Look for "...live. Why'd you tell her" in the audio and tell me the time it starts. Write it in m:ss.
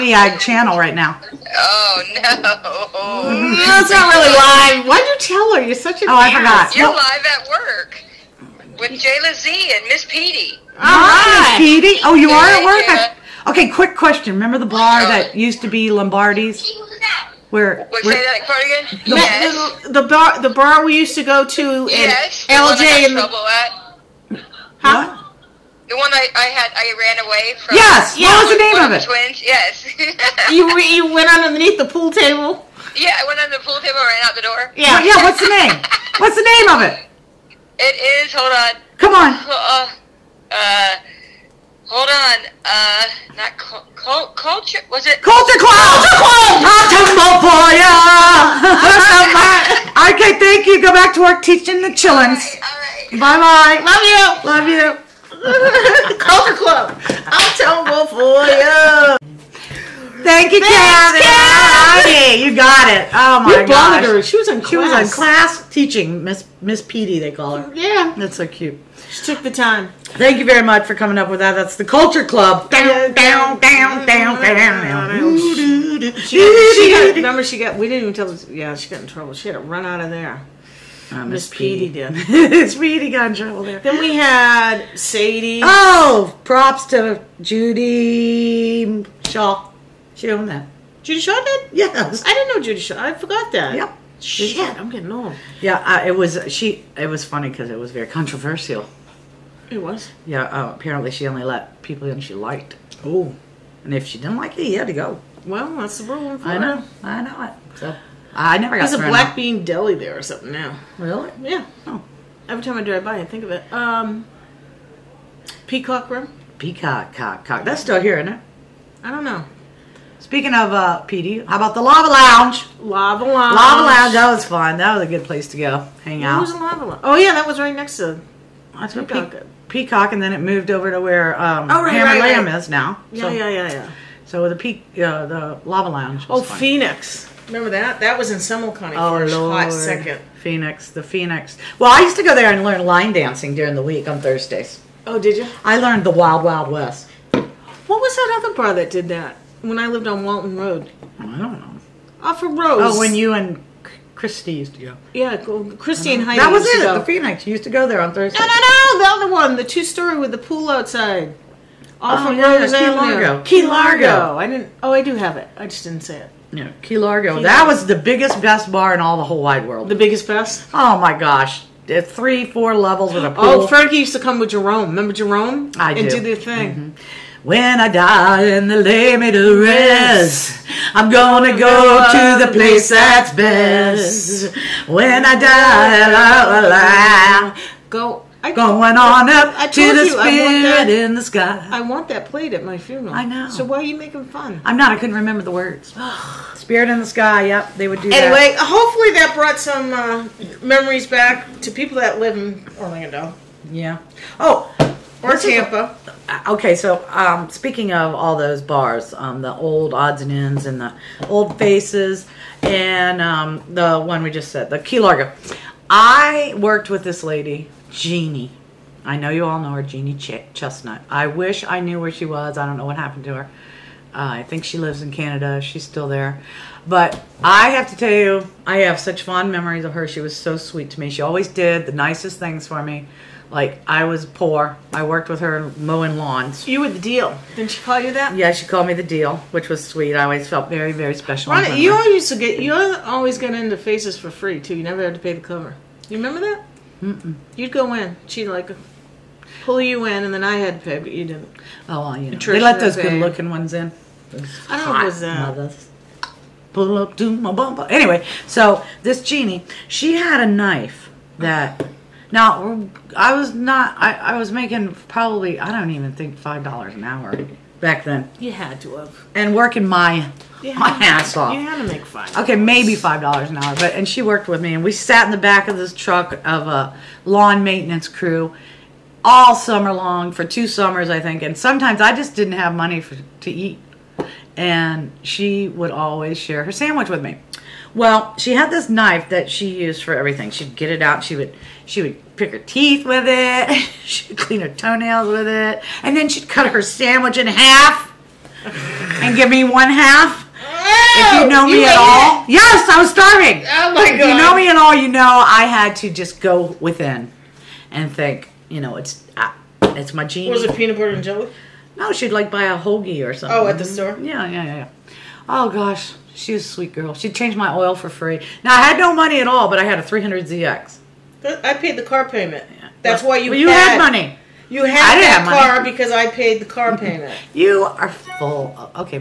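0:04.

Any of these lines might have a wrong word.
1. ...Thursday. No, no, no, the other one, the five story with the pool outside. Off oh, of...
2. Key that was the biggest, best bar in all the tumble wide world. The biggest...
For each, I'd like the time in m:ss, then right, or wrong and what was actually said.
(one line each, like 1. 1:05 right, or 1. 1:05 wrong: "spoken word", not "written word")
1. 2:38 wrong: "two", not "five"
2. 2:47 wrong: "whole", not "tumble".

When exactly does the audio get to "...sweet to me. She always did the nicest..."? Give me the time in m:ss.
3:50.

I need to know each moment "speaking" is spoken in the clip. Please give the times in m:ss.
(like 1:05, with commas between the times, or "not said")
2:00, 3:27.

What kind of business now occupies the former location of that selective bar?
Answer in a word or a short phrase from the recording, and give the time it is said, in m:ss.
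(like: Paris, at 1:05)
black bean deli, at 1:49.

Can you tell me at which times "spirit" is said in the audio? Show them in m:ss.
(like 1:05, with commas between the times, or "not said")
3:10, 3:16.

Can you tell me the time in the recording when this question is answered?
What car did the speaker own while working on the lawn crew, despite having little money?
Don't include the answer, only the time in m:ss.
5:20.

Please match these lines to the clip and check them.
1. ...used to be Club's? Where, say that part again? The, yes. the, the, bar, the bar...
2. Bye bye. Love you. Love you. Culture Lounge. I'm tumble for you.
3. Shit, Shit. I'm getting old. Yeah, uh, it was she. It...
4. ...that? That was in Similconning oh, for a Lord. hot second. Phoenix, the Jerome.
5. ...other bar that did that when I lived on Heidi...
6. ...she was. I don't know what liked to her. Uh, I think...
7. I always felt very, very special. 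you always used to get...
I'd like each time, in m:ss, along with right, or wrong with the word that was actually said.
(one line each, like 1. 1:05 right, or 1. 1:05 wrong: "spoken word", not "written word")
1. 0:15 wrong: "Lombardi", not "Club"
2. 0:53 wrong: "Club", not "Lounge"
3. 1:34 right
4. 2:17 wrong: "Phoenix", not "Jerome"
5. 2:28 wrong: "Walton", not "Heidi"
6. 3:42 wrong: "happened", not "liked"
7. 4:00 right.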